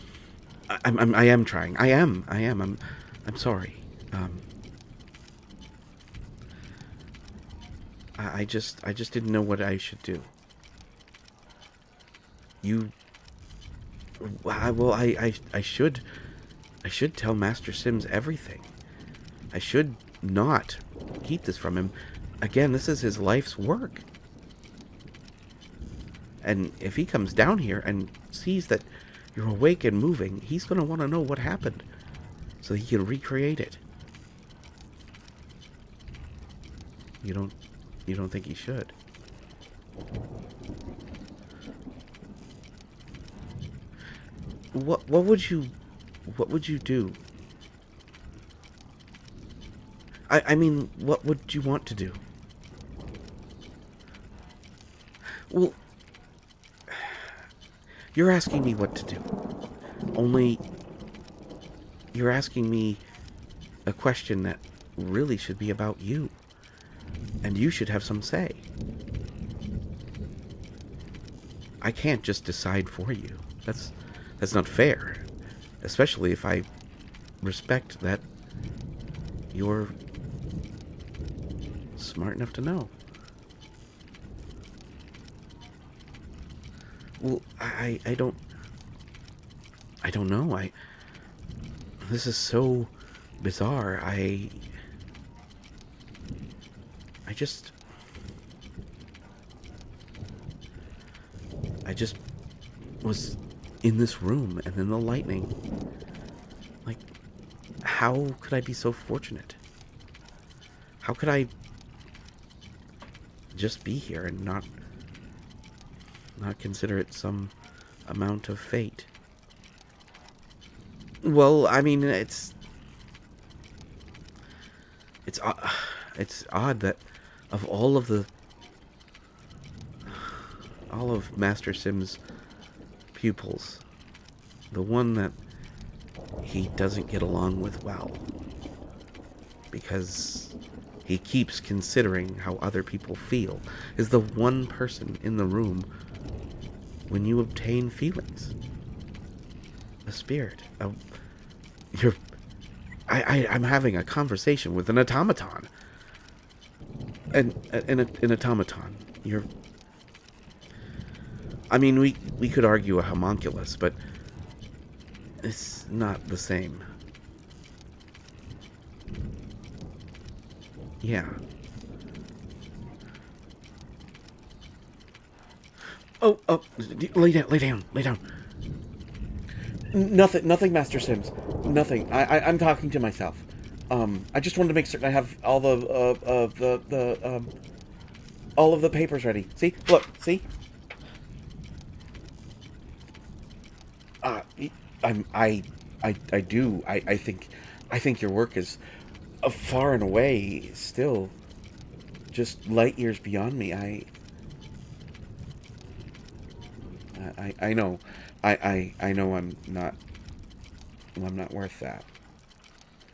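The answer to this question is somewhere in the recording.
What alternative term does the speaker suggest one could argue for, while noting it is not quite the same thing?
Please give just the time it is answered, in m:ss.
2:43.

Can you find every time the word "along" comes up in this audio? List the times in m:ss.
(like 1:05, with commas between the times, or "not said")
2:17.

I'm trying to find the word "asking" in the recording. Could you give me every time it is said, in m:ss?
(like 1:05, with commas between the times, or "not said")
0:58, 1:02.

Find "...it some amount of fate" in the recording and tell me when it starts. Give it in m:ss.
1:56.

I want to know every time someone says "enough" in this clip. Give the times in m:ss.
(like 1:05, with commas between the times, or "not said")
1:22.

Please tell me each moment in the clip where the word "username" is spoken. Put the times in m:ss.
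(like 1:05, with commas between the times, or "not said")
not said.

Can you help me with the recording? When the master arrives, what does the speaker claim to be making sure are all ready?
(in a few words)
The papers.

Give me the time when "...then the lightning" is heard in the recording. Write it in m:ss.
1:44.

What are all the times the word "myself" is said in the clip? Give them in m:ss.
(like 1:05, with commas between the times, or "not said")
3:02.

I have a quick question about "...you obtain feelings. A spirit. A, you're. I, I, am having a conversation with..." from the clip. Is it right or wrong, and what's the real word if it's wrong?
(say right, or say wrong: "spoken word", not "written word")
right.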